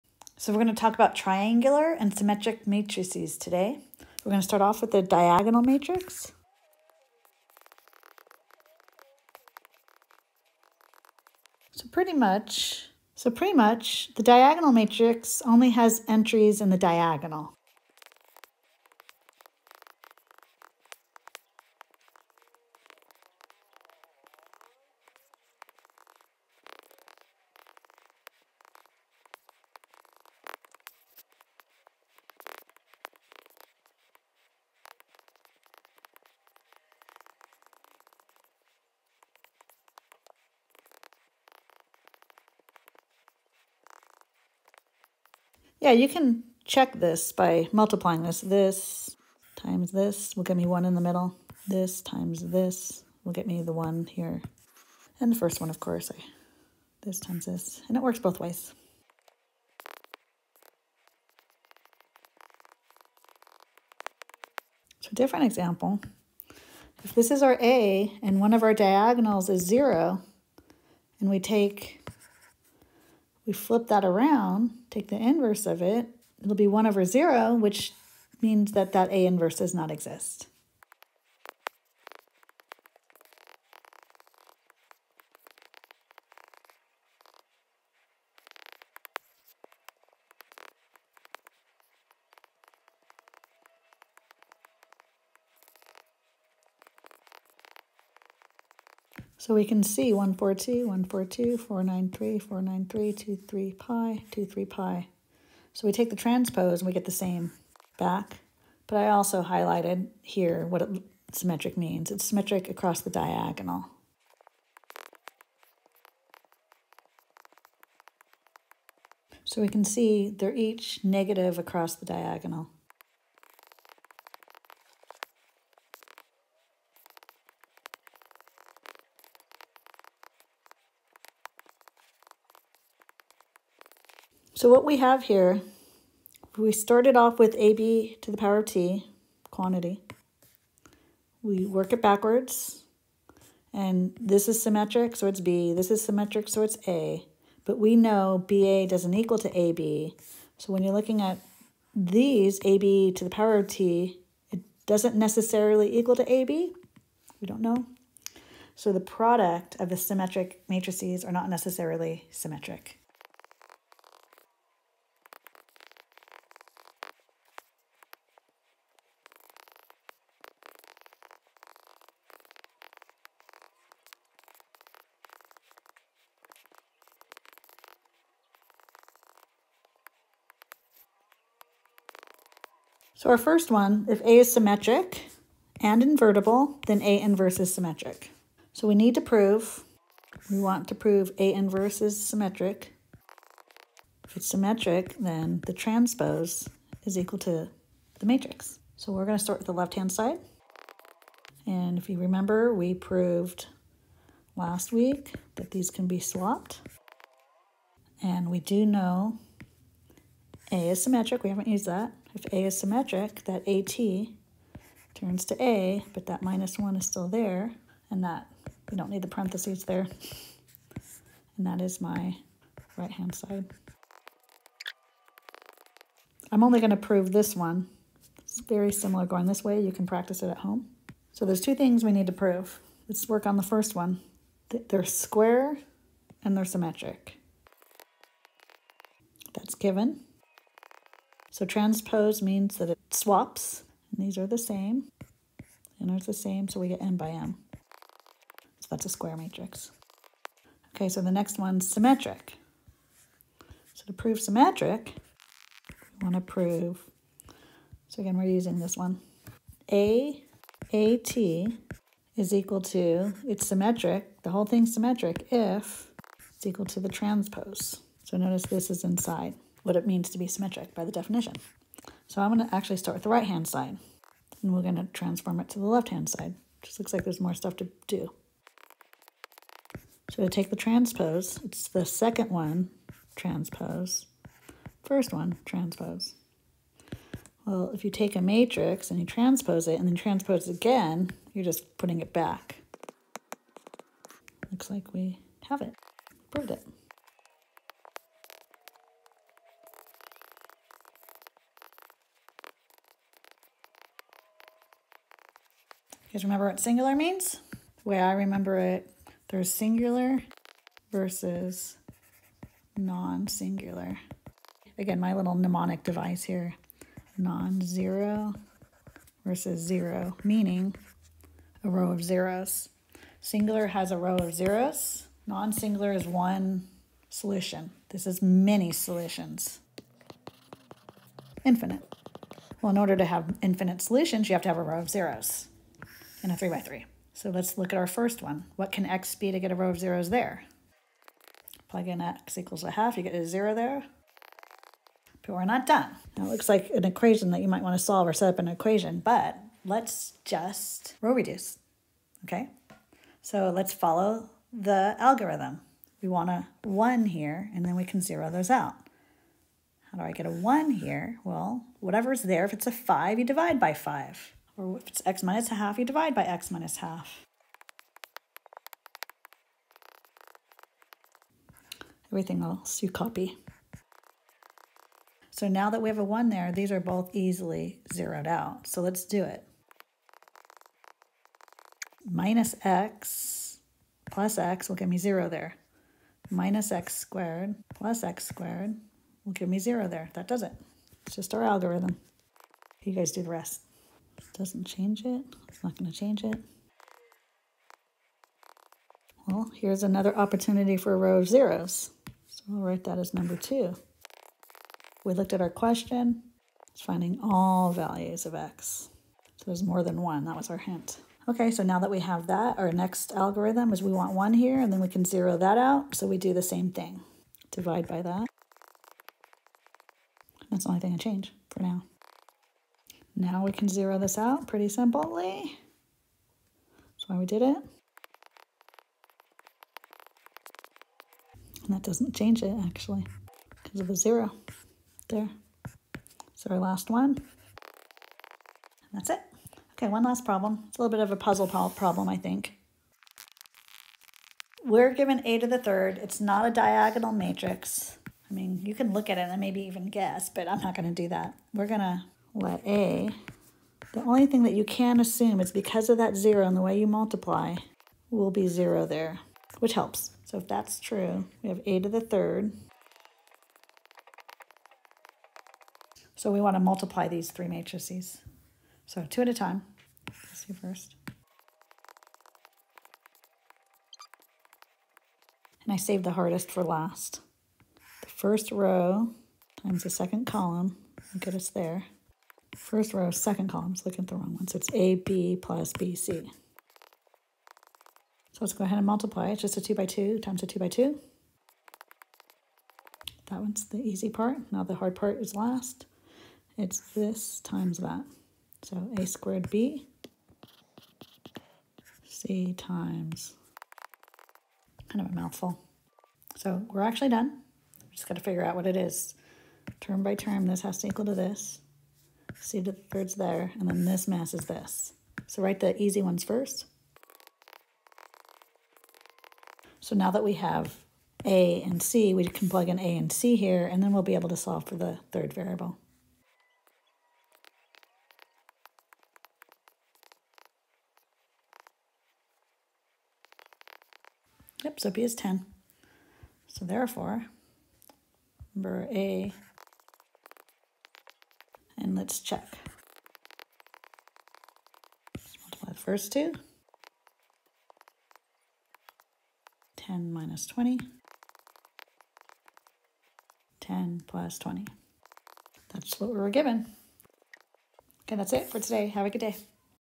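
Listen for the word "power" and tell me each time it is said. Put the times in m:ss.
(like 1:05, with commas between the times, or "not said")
2:18, 2:33.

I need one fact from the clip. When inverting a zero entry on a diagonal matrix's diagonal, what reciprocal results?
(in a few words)
1 over 0.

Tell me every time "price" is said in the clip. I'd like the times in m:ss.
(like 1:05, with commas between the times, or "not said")
not said.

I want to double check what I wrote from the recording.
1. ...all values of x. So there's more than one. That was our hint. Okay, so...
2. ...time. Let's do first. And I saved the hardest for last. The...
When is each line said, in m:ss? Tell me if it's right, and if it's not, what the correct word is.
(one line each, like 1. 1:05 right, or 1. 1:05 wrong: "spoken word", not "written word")
1. 6:47 right
2. 7:49 right.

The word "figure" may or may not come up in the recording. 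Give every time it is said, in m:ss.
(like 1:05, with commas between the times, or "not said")
8:28.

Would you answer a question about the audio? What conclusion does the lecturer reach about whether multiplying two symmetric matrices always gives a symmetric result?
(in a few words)
not necessarily symmetric.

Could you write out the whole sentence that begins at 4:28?
So notice this is inside what it means to be symmetric by the definition.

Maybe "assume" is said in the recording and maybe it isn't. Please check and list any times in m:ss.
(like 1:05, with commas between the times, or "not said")
7:35.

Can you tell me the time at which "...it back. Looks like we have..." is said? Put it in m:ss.
4:52.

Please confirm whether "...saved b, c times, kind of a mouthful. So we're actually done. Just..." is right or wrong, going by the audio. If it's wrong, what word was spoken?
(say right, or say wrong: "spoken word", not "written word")
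wrong: "squared", not "saved".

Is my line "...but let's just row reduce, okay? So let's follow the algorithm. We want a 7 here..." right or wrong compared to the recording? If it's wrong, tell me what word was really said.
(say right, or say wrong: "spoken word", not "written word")
wrong: "1", not "7".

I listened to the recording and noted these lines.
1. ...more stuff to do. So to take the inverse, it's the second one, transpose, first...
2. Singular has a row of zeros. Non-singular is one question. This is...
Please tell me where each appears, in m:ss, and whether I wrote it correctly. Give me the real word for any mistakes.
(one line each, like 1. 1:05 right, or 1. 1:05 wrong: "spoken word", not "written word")
1. 4:37 wrong: "transpose", not "inverse"
2. 5:23 wrong: "solution", not "question".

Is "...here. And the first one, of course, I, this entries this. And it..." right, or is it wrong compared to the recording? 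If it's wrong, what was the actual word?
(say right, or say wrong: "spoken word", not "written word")
wrong: "times", not "entries".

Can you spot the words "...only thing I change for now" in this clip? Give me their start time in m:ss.
7:00.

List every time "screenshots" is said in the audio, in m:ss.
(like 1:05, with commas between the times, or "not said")
not said.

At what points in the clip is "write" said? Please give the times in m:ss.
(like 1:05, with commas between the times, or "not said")
6:42, 8:35.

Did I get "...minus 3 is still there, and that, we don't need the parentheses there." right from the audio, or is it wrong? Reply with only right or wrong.
wrong.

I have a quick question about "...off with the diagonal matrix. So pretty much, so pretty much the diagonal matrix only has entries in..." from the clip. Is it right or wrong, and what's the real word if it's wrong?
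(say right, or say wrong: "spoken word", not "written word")
right.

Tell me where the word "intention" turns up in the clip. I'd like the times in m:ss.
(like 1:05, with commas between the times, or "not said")
not said.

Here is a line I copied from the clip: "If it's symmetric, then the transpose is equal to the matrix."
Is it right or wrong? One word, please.
right.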